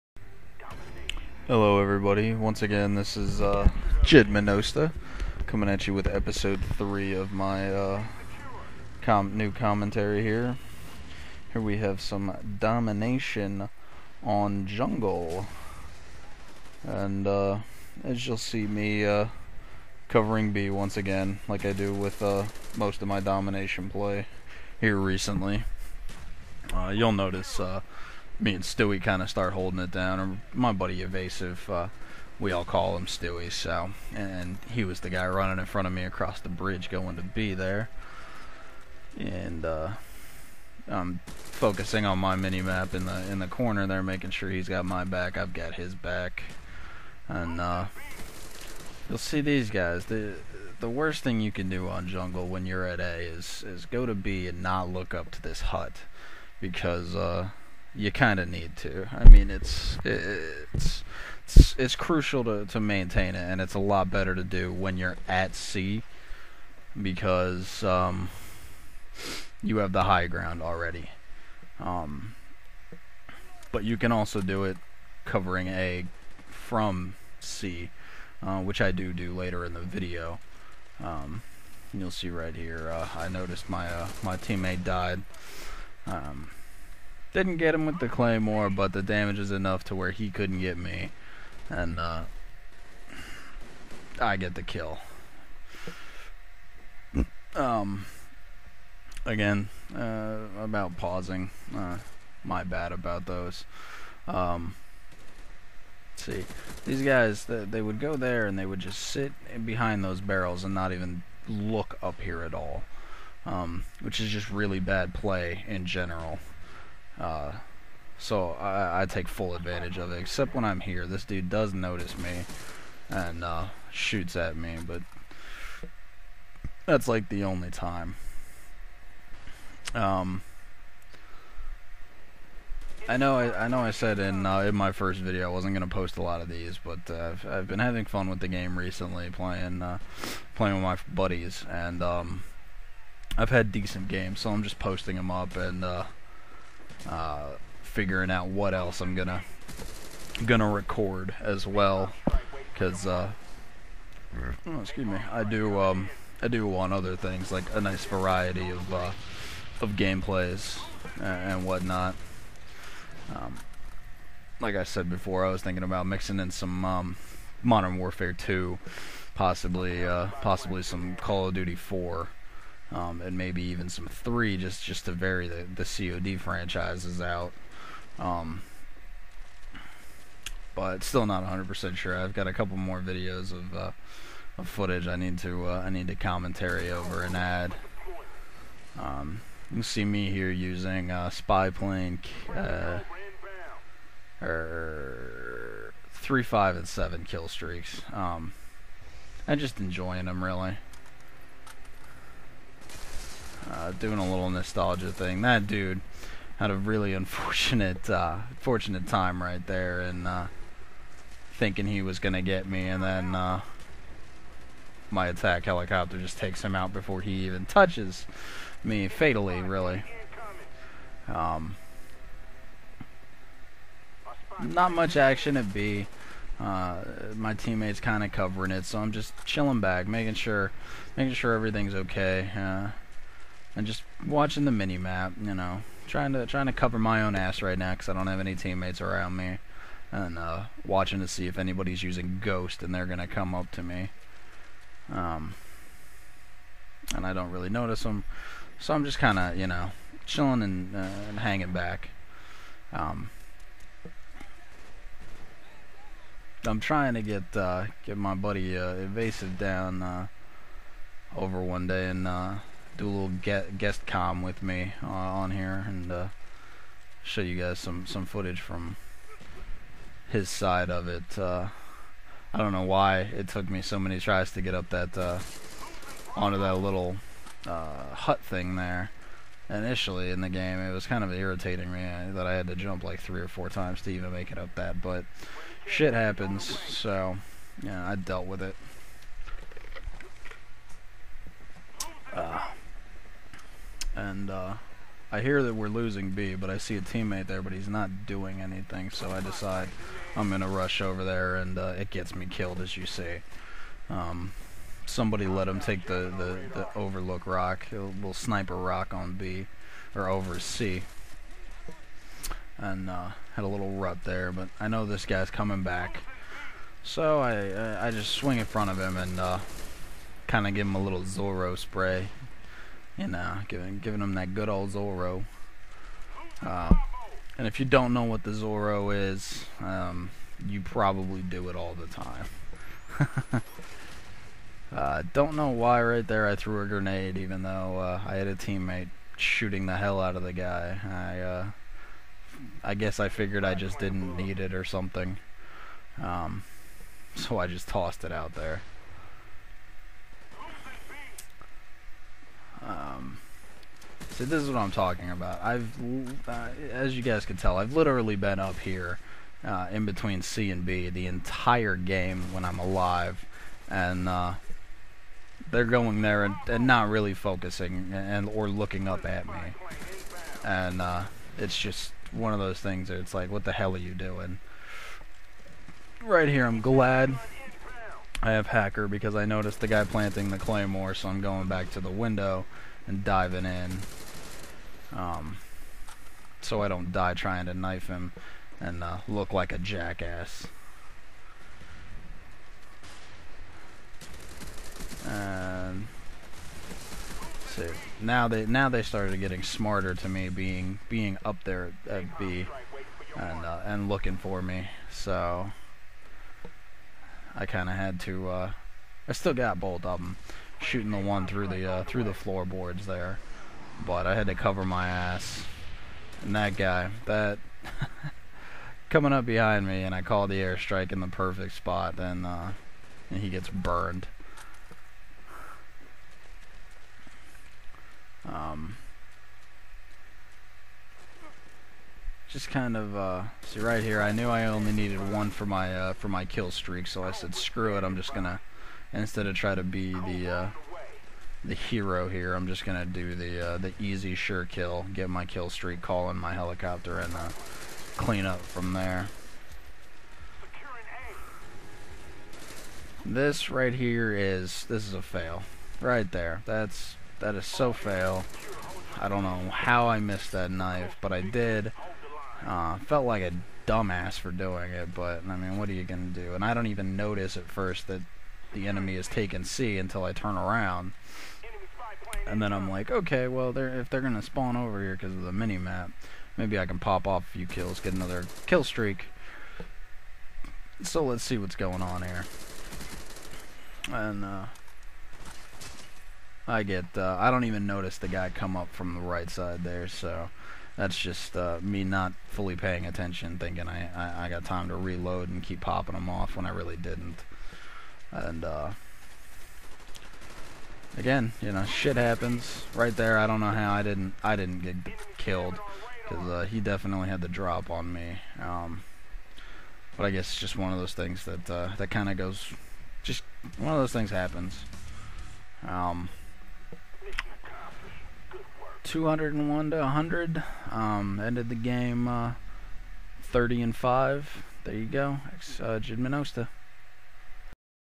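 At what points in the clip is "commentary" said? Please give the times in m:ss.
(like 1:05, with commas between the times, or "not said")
0:09, 3:06.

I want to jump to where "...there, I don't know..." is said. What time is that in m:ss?
8:23.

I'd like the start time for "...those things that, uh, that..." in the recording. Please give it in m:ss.
8:30.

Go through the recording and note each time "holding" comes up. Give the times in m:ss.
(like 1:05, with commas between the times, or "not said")
0:29.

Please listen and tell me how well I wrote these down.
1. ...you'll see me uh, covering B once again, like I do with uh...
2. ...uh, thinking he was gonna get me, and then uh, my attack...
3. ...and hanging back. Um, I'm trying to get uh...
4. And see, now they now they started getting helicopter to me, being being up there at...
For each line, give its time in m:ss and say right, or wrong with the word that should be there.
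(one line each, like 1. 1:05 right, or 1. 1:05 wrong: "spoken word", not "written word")
1. 0:18 right
2. 3:30 right
3. 4:11 right
4. 6:35 wrong: "smarter", not "helicopter".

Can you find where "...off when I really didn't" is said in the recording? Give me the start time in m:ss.
8:16.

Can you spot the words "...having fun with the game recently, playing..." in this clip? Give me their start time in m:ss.
2:17.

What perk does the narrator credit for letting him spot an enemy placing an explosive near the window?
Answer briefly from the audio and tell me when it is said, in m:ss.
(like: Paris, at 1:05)
Hacker, at 6:18.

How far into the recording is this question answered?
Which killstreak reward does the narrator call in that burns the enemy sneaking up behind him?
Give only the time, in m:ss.
7:00.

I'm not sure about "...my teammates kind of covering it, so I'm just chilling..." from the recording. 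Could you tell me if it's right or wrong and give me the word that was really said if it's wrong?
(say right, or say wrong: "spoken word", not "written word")
right.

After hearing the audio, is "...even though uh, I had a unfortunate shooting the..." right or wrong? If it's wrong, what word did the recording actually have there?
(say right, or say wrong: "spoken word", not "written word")
wrong: "teammate", not "unfortunate".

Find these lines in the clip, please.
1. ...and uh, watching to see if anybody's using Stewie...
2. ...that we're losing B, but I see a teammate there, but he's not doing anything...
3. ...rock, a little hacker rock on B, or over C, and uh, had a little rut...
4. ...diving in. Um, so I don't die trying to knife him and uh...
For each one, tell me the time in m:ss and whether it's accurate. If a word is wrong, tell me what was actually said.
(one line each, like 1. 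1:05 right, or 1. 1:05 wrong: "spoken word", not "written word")
1. 4:00 wrong: "Ghost", not "Stewie"
2. 4:55 right
3. 5:07 wrong: "sniper", not "hacker"
4. 6:23 right.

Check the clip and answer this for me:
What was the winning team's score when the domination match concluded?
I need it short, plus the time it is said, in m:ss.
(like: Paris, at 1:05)
201, at 8:39.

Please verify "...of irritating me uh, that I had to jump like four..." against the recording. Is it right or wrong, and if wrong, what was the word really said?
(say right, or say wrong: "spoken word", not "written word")
wrong: "three", not "four".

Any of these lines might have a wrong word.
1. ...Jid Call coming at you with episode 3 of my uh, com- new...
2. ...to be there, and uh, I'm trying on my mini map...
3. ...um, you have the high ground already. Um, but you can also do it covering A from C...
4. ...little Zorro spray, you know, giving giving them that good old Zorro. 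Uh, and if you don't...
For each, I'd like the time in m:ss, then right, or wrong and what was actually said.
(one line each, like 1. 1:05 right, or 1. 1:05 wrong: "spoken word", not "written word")
1. 0:04 wrong: "Menosta", not "Call"
2. 0:37 wrong: "focusing", not "trying"
3. 1:07 right
4. 5:21 right.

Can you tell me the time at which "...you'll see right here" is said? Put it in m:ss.
1:21.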